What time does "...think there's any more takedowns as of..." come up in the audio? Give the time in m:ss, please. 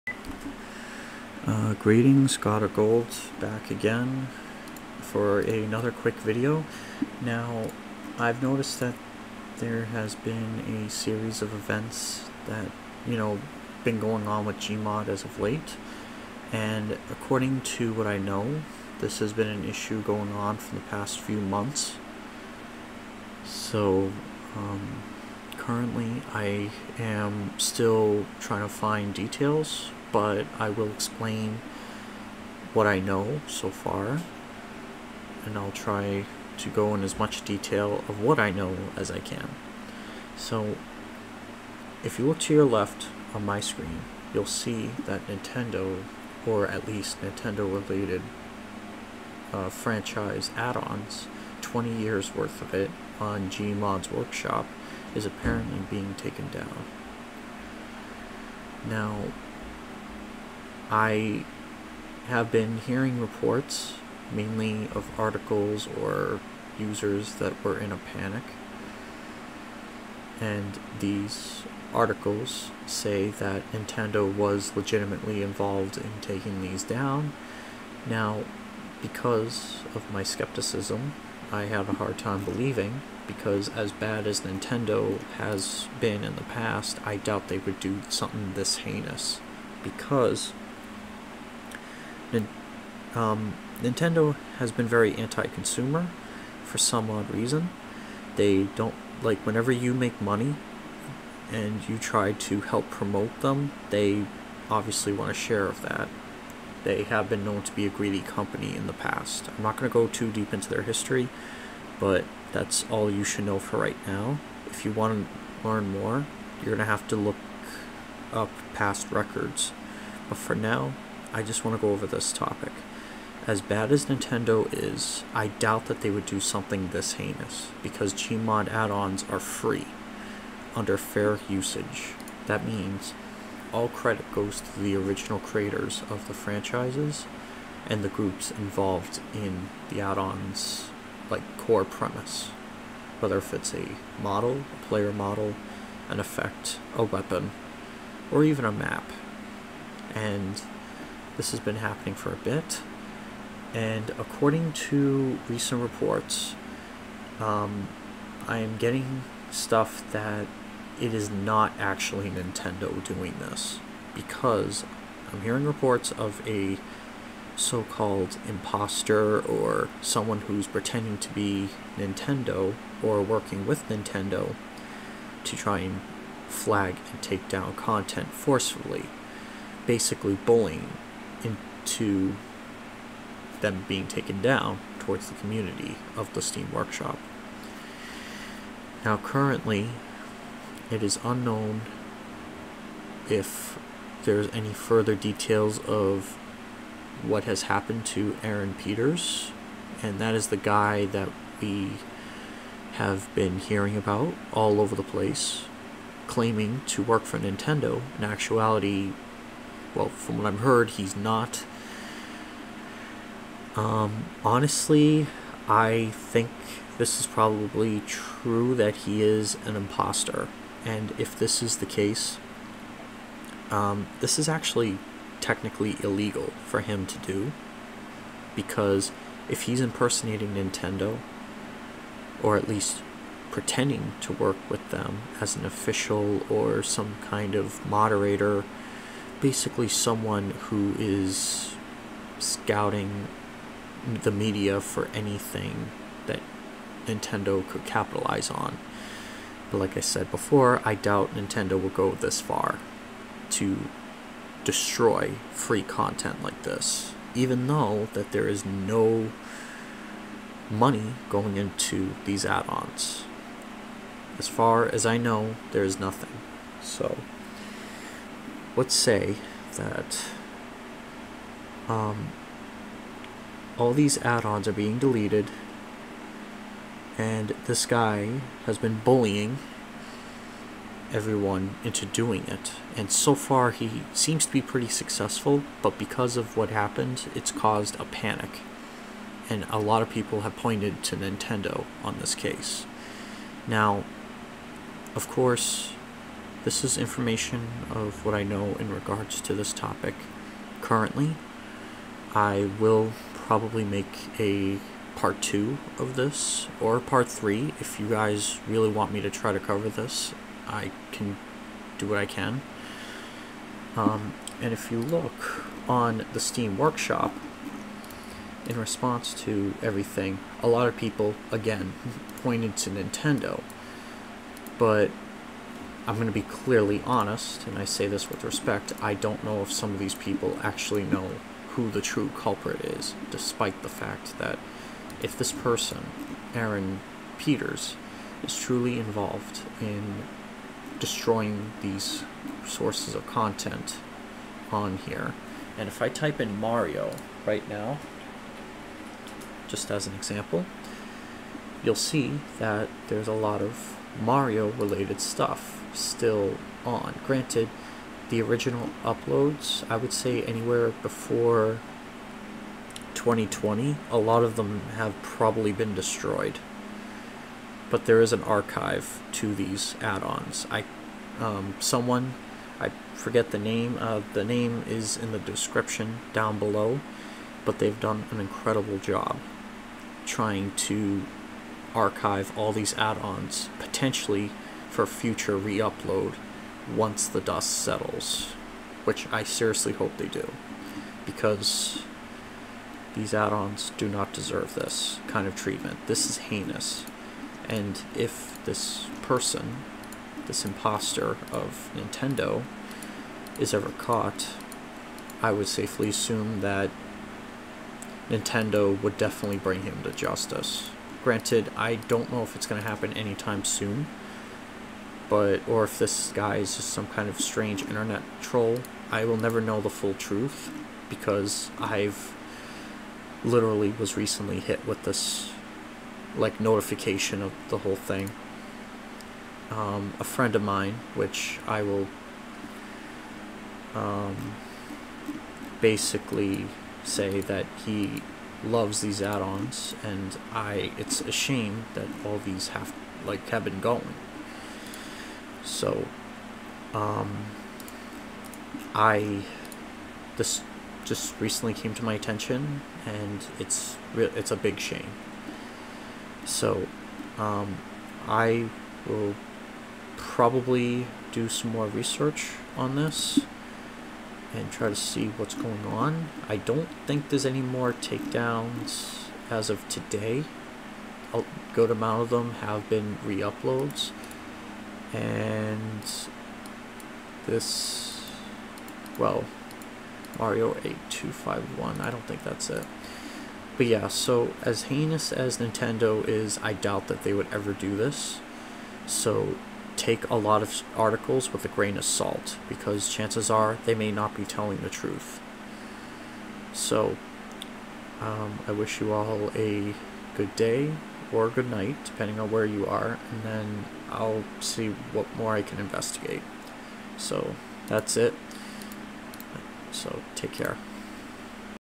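7:47.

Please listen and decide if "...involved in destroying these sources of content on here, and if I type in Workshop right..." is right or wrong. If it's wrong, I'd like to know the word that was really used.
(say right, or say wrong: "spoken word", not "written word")
wrong: "Mario", not "Workshop".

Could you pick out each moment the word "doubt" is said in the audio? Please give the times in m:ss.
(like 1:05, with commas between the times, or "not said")
1:27, 2:05, 4:10, 8:06.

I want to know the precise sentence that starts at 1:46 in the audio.
They have been known to be a greedy company in the past.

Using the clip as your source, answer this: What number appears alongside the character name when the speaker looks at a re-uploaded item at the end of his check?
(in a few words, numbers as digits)
8251.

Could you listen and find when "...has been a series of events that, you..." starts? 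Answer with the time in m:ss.
0:09.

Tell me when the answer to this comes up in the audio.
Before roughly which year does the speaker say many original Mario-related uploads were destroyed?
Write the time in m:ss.
6:03.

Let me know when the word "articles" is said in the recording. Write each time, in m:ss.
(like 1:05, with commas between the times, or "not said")
1:05, 1:11, 8:10.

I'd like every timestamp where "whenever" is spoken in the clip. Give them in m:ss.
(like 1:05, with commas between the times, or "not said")
1:39.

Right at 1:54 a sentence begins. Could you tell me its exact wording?
If you want to learn more, you're going to have to look up past records.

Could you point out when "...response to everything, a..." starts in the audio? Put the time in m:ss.
5:18.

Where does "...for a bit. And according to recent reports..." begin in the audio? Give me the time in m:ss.
2:32.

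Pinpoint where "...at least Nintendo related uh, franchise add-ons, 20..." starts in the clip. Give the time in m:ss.
0:46.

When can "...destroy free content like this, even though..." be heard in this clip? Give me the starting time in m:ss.
4:14.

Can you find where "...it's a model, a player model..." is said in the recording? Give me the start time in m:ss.
2:23.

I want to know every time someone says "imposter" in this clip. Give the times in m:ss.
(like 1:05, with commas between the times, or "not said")
2:48, 3:39, 6:40.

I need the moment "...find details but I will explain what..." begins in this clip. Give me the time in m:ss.
0:28.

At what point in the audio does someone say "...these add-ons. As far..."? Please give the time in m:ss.
4:22.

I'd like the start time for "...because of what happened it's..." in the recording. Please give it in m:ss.
4:45.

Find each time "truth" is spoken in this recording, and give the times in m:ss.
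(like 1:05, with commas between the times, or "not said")
7:00, 8:14.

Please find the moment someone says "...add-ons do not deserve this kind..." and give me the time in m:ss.
6:33.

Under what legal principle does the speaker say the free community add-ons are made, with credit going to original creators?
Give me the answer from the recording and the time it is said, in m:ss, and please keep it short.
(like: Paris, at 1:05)
fair usage, at 2:10.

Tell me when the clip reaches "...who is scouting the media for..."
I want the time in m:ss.
4:00.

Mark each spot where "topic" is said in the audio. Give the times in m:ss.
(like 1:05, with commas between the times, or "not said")
2:02, 4:59.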